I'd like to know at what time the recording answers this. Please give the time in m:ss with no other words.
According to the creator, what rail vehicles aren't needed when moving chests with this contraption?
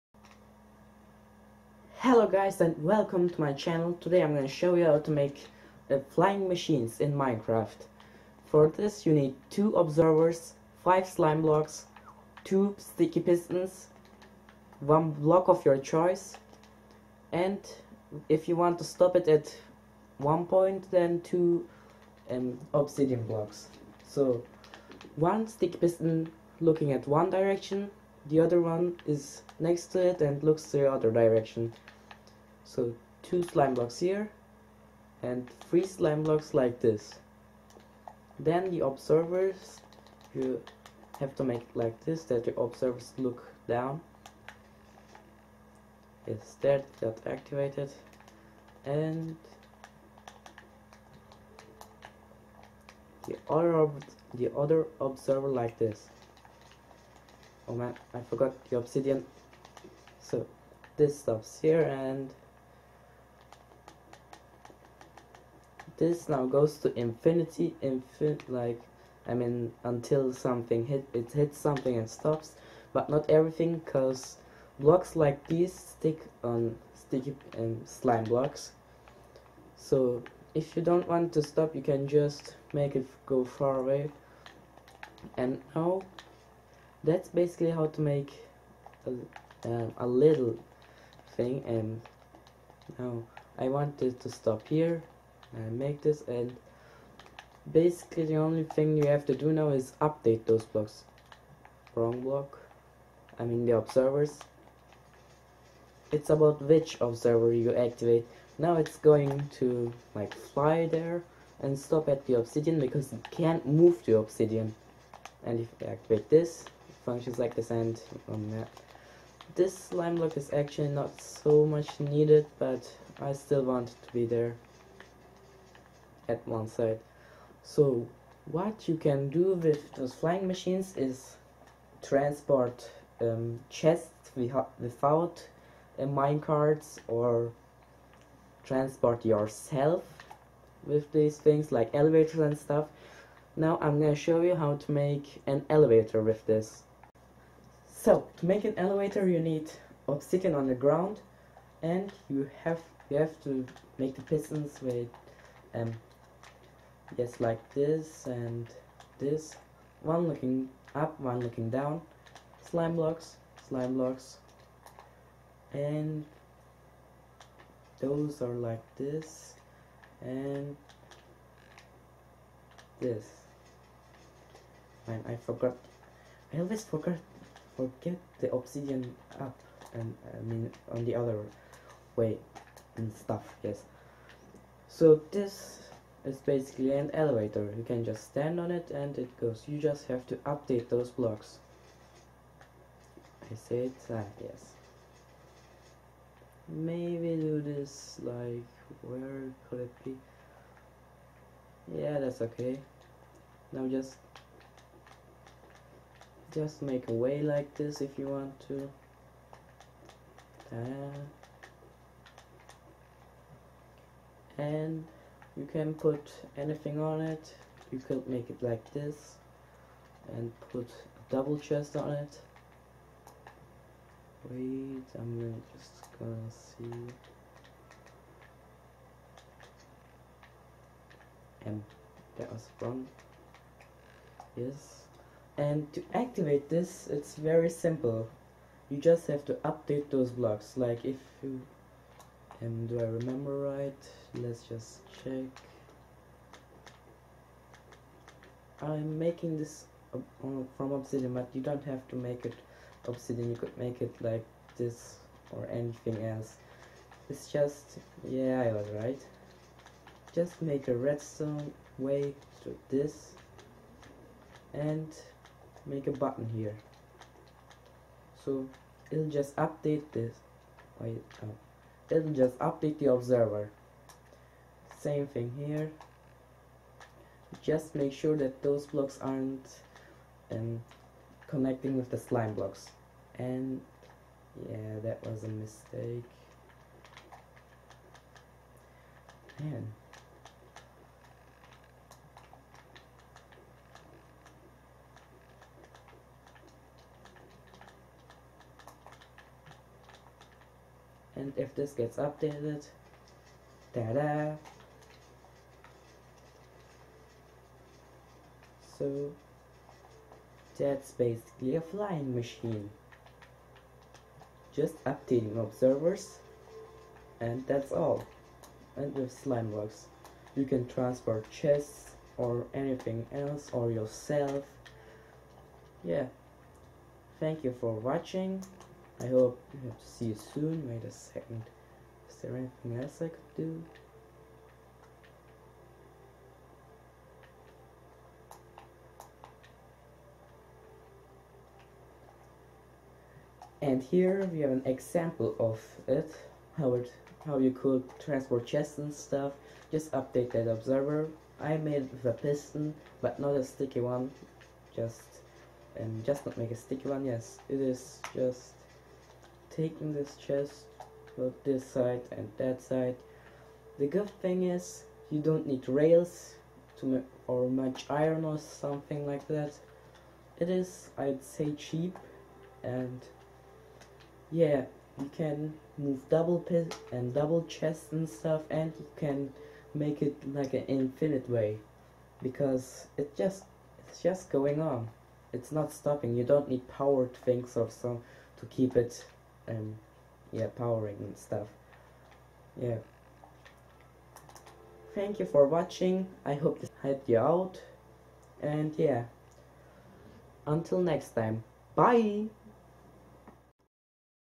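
2:16.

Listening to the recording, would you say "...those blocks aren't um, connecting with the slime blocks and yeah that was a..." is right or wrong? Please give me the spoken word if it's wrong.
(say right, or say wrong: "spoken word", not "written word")
right.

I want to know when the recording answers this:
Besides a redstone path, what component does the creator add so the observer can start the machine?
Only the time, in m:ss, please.
4:26.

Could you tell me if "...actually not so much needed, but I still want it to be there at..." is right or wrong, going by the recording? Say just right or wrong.
right.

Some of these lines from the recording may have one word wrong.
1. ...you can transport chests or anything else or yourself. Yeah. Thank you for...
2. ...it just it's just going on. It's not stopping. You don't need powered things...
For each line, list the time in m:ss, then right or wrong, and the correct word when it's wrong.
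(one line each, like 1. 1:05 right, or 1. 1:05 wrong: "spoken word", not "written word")
1. 5:20 right
2. 6:23 right.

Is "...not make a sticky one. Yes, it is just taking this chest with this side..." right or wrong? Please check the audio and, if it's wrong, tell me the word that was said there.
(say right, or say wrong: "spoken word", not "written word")
right.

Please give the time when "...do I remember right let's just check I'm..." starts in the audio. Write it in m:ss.
4:02.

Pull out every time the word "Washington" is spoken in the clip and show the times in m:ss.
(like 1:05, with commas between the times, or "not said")
not said.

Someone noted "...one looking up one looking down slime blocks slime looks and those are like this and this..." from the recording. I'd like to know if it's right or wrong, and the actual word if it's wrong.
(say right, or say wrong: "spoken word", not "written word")
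wrong: "blocks", not "looks".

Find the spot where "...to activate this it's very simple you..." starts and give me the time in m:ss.
3:55.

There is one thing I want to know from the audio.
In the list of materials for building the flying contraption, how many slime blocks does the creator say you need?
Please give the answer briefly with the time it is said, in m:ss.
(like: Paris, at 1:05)
5, at 0:10.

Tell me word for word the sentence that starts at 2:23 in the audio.
Now I'm gonna show you how to make an elevator with this.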